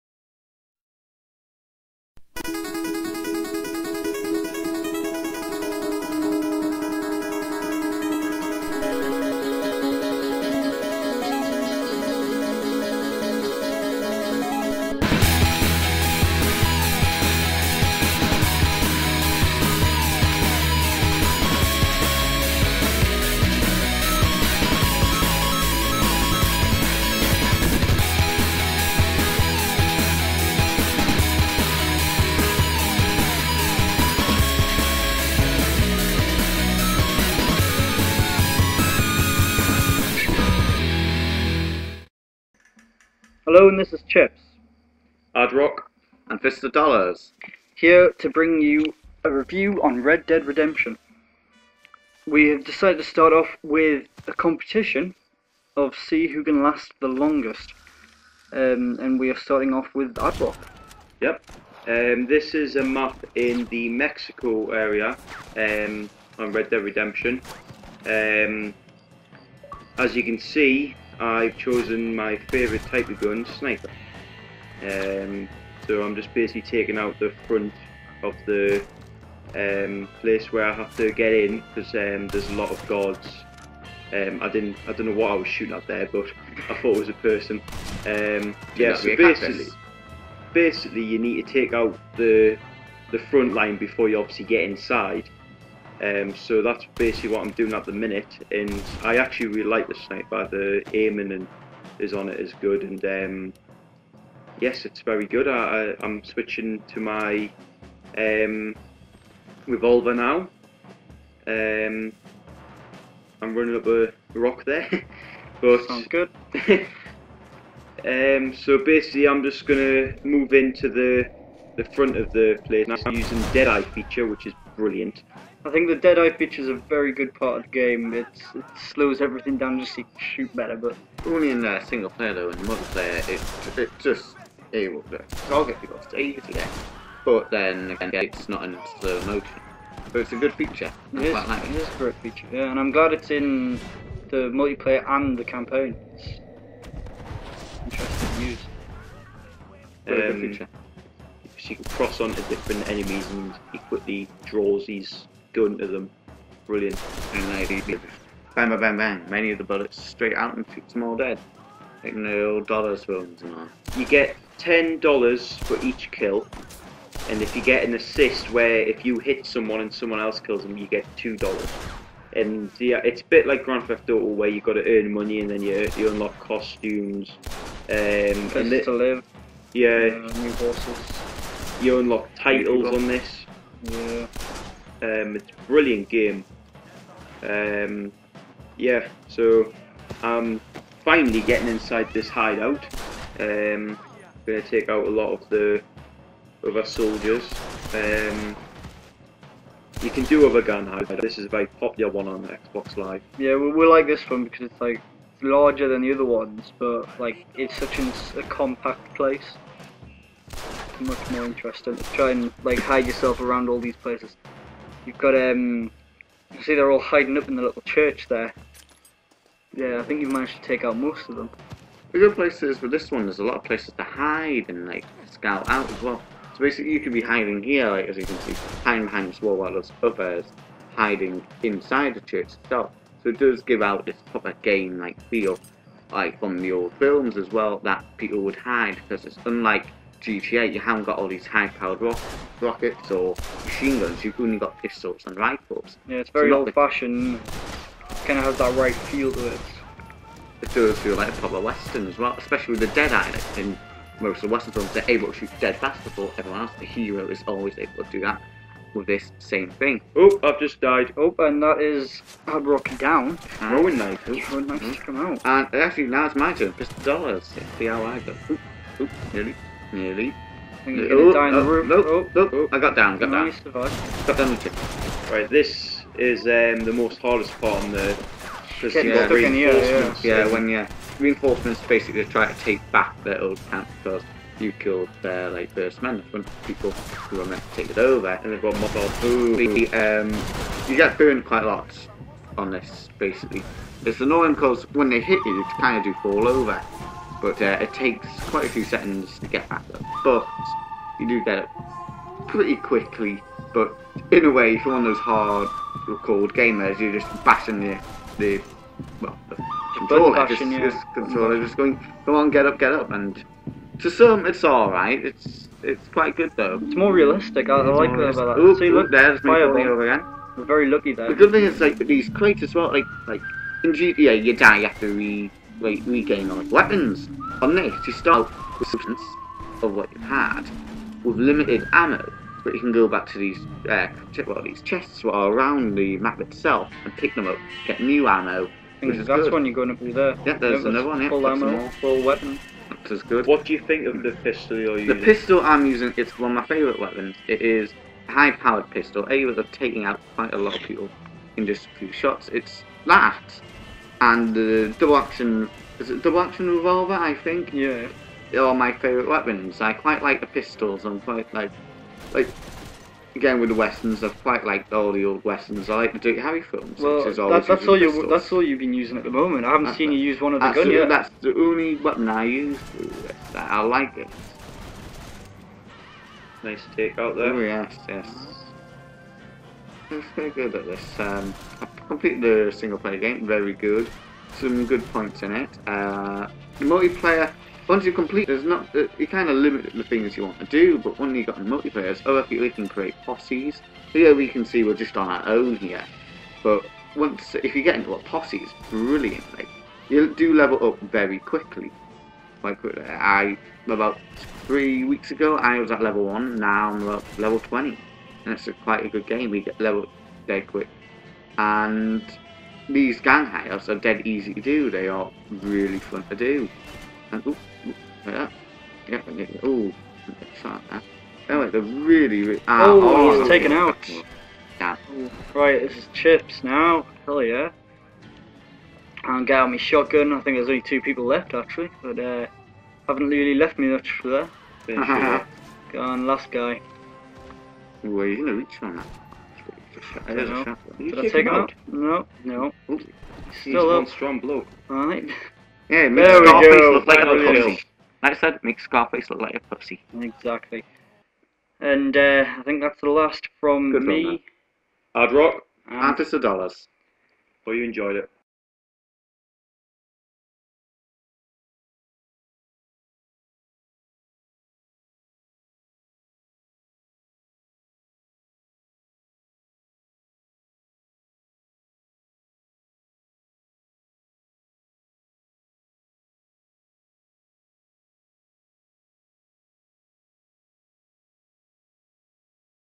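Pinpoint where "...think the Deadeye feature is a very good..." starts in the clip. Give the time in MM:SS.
02:05.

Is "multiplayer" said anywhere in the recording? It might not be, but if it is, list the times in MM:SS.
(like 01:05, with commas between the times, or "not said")
02:12, 02:24, 06:26, 06:31.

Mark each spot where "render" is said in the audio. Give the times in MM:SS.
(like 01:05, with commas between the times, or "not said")
not said.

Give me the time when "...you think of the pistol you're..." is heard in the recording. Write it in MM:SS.
05:43.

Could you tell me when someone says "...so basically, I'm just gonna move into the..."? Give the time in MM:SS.
01:58.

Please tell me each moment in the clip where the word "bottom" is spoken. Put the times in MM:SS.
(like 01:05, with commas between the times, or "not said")
not said.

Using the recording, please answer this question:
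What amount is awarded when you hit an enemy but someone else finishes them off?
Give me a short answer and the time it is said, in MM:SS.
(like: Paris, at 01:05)
$2, at 02:51.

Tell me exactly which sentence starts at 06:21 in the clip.
Um, I've completed the single player game, very good.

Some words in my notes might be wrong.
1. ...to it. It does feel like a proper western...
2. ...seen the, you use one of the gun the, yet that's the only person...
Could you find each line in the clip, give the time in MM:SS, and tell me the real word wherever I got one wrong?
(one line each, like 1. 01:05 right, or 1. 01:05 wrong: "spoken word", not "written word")
1. 04:09 right
2. 06:09 wrong: "weapon", not "person".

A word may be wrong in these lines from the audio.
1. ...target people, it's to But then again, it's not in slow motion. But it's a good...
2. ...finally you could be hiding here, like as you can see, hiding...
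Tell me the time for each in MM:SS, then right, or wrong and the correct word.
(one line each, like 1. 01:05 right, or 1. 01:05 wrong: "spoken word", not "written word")
1. 02:15 right
2. 03:46 wrong: "basically", not "finally".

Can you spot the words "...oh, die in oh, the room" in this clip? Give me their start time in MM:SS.
04:31.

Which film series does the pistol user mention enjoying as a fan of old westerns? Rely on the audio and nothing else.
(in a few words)
Dirty Harry.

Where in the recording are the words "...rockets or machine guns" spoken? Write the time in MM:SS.
04:02.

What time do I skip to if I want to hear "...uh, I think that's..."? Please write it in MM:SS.
07:32.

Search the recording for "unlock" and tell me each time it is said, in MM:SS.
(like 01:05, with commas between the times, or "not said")
02:56, 03:01.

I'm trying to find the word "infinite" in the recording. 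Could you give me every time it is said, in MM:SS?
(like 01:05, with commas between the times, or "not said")
not said.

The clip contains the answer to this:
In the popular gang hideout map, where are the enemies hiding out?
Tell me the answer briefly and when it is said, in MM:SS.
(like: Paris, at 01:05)
The little church, at 03:37.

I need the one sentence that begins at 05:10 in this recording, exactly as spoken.
just controller, just going, come on, get up, get up, and to some it's all right.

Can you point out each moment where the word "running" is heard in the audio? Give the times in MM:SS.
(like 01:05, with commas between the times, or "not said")
01:53.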